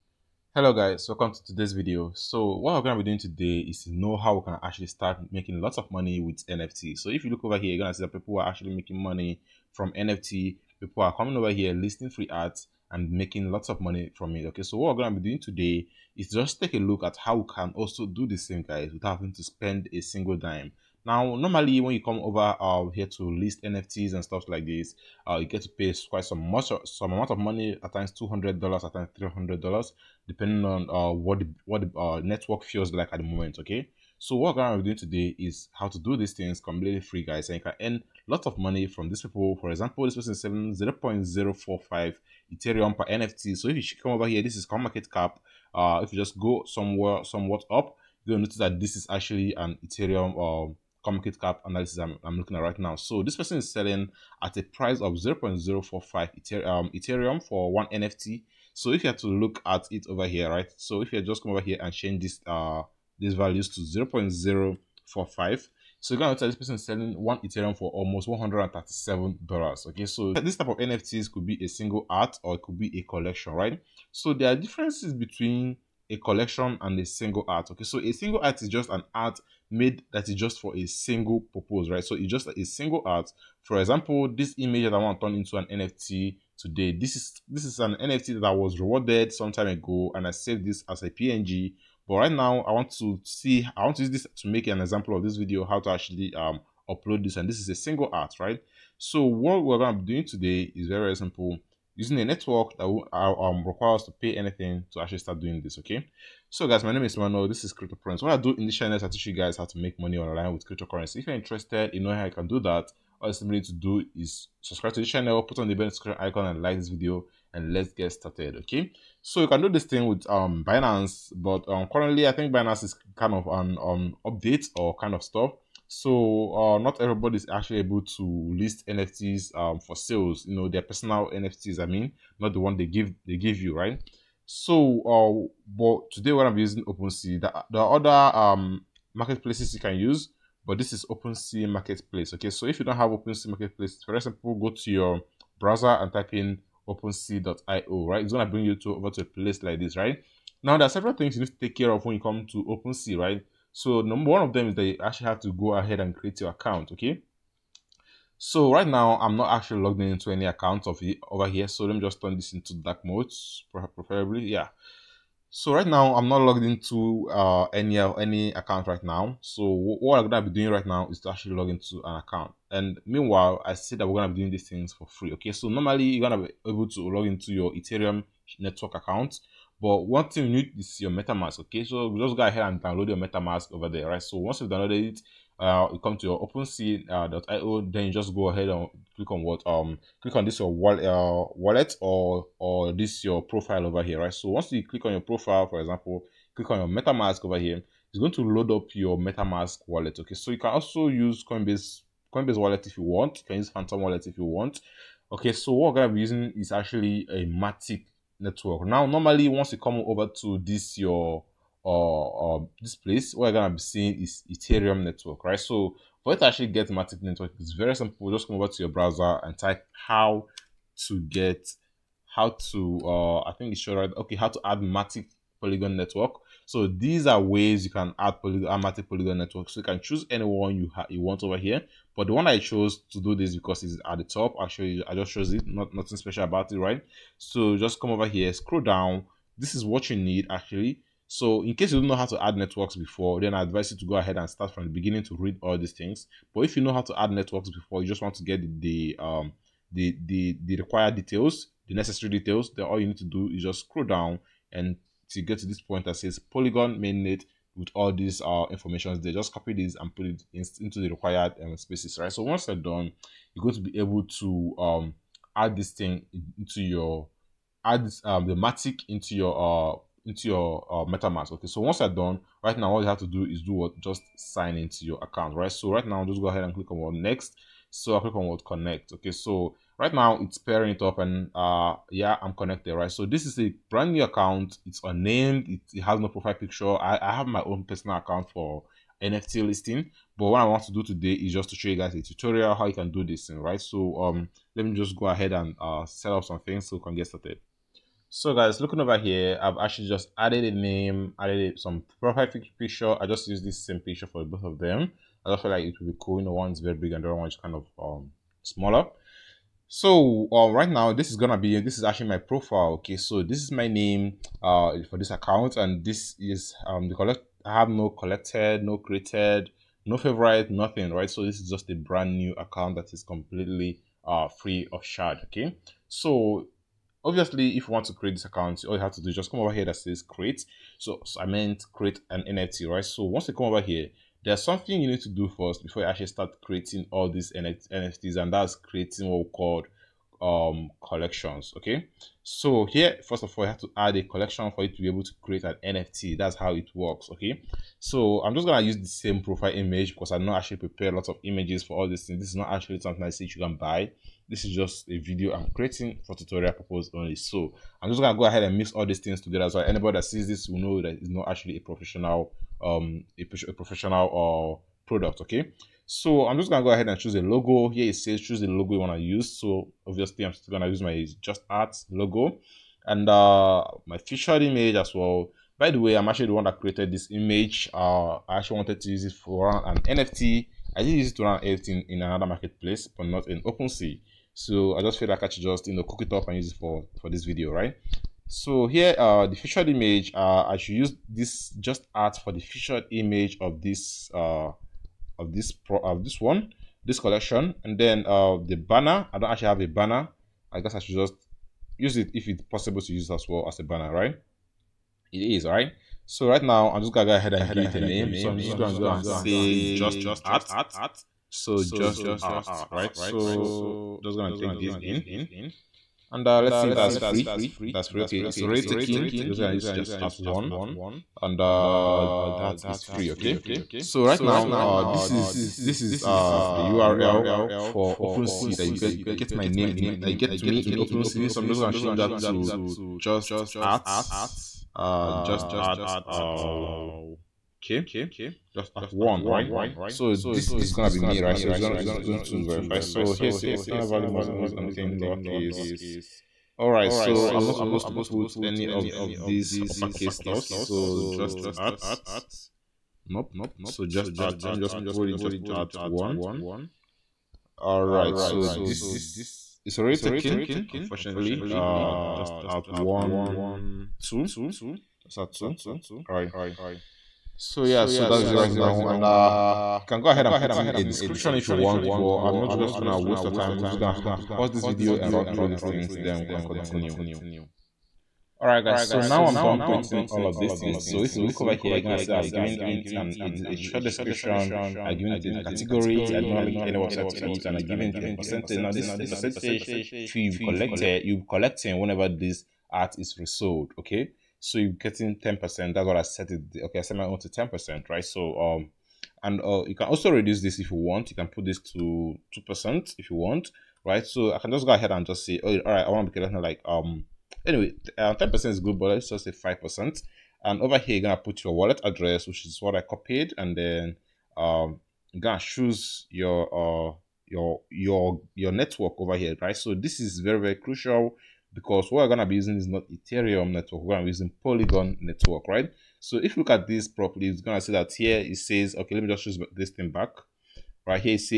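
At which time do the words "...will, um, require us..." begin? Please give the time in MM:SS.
01:42.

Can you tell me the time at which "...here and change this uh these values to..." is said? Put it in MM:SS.
01:01.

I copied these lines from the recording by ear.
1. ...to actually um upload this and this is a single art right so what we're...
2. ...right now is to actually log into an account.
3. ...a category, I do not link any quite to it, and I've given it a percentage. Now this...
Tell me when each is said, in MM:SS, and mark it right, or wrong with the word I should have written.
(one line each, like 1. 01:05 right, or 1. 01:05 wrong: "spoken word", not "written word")
1. 01:35 right
2. 02:50 right
3. 08:05 wrong: "website", not "quite".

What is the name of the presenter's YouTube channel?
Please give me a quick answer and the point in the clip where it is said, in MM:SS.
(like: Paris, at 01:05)
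Crypto Prince, at 01:47.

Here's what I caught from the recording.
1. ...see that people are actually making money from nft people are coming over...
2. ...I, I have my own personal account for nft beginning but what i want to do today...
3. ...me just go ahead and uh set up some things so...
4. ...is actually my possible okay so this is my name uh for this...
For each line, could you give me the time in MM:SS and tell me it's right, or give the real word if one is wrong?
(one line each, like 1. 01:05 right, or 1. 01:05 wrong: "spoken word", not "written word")
1. 00:07 right
2. 04:46 wrong: "listing", not "beginning"
3. 04:54 right
4. 05:11 wrong: "profile", not "possible".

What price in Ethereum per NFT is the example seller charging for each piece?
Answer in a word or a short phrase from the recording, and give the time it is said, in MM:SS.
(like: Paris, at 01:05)
0.045 Ethereum, at 00:40.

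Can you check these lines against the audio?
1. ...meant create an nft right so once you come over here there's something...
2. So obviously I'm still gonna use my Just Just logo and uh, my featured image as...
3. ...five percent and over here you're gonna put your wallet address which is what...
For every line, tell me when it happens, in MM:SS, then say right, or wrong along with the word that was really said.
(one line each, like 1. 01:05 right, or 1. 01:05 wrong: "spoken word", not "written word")
1. 05:31 right
2. 06:09 wrong: "Art", not "Just"
3. 08:29 right.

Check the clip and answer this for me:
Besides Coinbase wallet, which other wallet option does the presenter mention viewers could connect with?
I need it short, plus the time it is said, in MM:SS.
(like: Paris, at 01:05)
Phantom wallet, at 03:23.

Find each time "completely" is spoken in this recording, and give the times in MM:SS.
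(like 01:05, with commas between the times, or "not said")
00:36, 05:23.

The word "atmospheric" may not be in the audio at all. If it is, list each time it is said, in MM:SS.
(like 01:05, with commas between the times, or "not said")
not said.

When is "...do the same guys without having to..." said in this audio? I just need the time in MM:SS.
00:18.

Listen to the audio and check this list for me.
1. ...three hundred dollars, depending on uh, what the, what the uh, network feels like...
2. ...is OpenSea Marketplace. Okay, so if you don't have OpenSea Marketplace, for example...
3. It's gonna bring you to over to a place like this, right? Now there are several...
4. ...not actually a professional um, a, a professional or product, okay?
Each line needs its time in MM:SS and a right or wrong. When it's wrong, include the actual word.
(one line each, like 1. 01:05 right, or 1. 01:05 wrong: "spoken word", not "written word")
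1. 00:29 right
2. 02:20 right
3. 02:28 right
4. 06:01 right.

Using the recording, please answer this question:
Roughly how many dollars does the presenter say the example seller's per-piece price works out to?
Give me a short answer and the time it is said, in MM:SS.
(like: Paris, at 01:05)
$137, at 01:08.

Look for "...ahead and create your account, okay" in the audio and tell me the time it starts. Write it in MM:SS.
02:35.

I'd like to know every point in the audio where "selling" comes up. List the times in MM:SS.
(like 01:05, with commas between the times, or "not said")
00:40, 00:53, 01:06.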